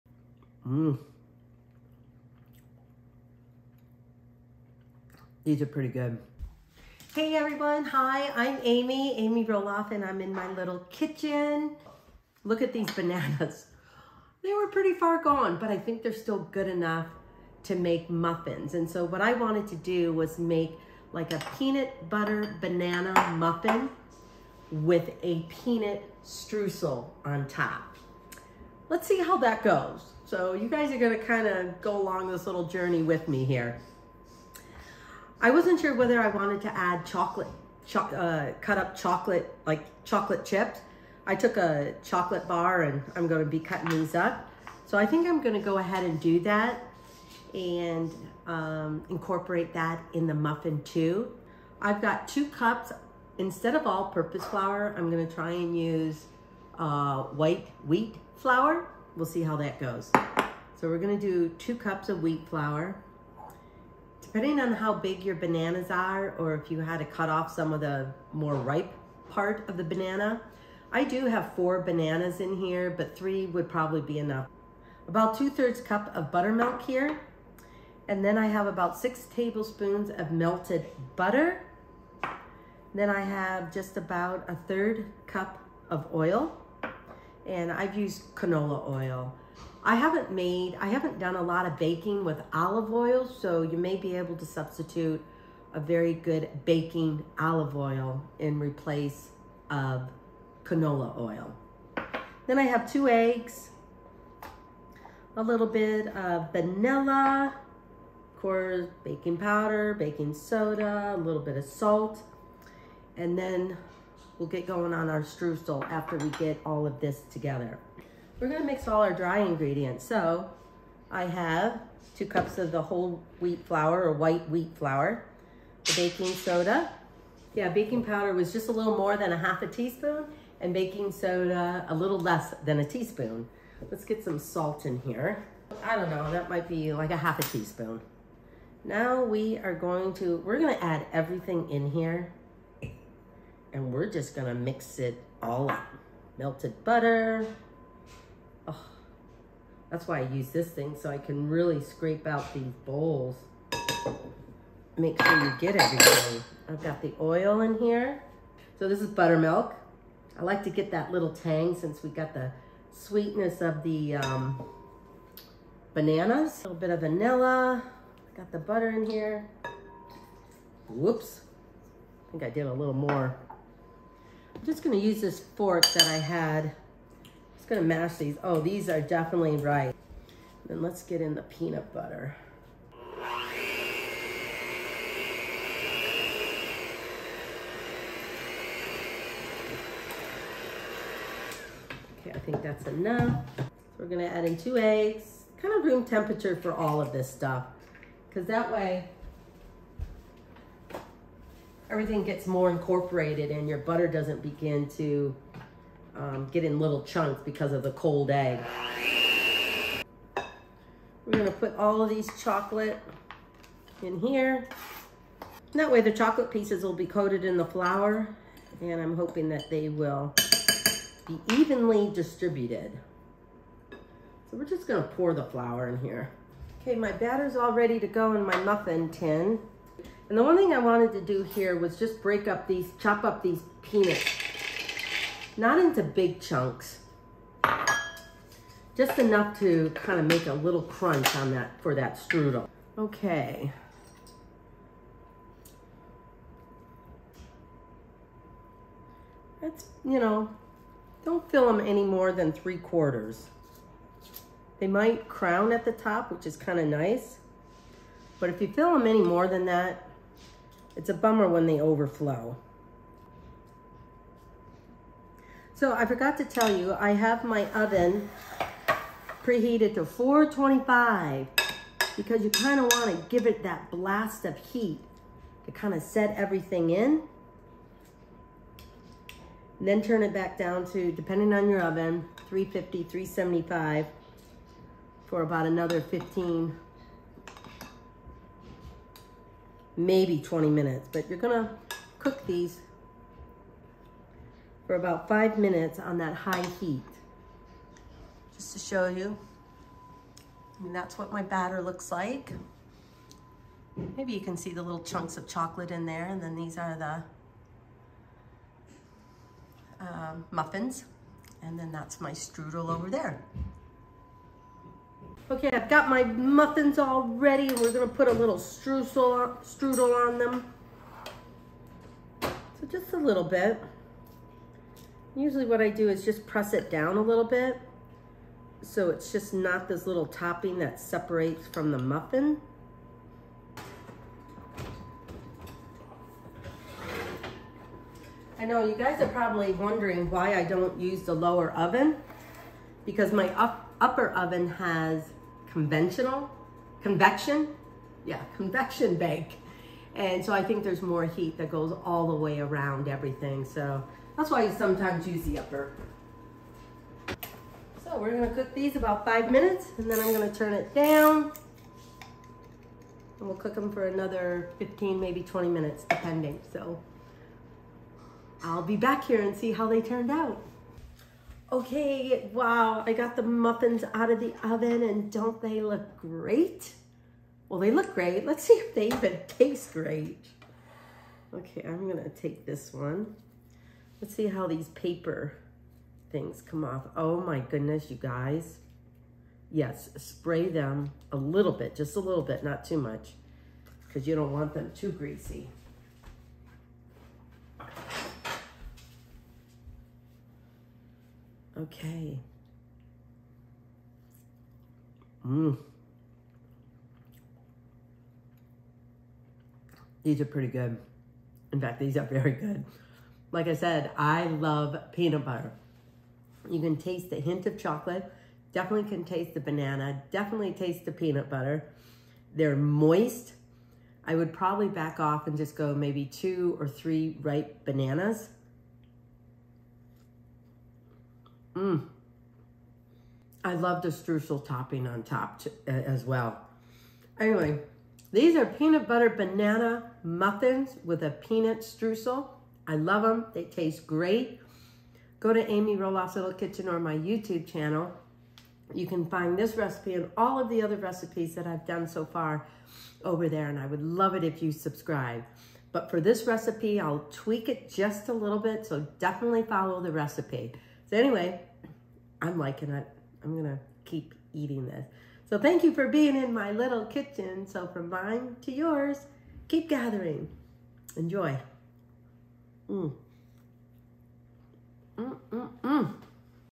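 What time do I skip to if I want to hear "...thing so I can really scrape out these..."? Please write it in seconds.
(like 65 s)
150 s.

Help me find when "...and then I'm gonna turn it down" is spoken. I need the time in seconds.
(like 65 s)
359 s.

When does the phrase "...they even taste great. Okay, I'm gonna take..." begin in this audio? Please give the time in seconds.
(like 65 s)
378 s.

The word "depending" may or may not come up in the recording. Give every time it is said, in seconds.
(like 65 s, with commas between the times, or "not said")
64 s, 281 s, 366 s.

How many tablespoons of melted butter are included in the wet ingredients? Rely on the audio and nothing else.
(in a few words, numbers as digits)
6.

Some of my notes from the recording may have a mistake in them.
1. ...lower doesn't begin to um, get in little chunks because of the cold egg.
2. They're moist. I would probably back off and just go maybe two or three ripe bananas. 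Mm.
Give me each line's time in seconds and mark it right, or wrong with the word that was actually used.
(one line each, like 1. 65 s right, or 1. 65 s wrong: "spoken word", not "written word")
1. 203 s wrong: "butter", not "lower"
2. 422 s right.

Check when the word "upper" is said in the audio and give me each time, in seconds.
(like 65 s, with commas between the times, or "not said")
343 s, 355 s.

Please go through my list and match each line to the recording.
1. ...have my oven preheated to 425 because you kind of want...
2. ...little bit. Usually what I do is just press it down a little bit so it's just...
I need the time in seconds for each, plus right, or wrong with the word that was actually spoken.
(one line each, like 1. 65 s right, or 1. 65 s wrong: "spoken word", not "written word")
1. 267 s right
2. 323 s right.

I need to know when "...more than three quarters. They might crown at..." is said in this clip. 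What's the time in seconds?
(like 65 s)
252 s.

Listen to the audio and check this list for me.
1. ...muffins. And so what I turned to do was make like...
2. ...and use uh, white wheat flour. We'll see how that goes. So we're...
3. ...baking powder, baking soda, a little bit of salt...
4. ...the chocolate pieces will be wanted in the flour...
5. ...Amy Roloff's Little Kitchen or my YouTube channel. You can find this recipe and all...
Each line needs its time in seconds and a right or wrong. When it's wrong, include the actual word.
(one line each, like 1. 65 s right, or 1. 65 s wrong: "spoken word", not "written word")
1. 18 s wrong: "wanted", not "turned"
2. 55 s right
3. 109 s right
4. 216 s wrong: "coated", not "wanted"
5. 445 s right.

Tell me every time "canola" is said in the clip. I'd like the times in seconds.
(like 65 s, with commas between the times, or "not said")
88 s, 100 s.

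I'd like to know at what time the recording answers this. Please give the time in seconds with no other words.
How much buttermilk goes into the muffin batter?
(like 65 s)
75 s.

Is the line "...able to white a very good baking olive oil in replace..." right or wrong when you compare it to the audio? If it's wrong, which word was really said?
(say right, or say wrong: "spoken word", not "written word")
wrong: "substitute", not "white".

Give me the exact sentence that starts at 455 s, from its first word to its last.
But for this recipe, I'll tweak it just a little bit, so definitely follow the recipe.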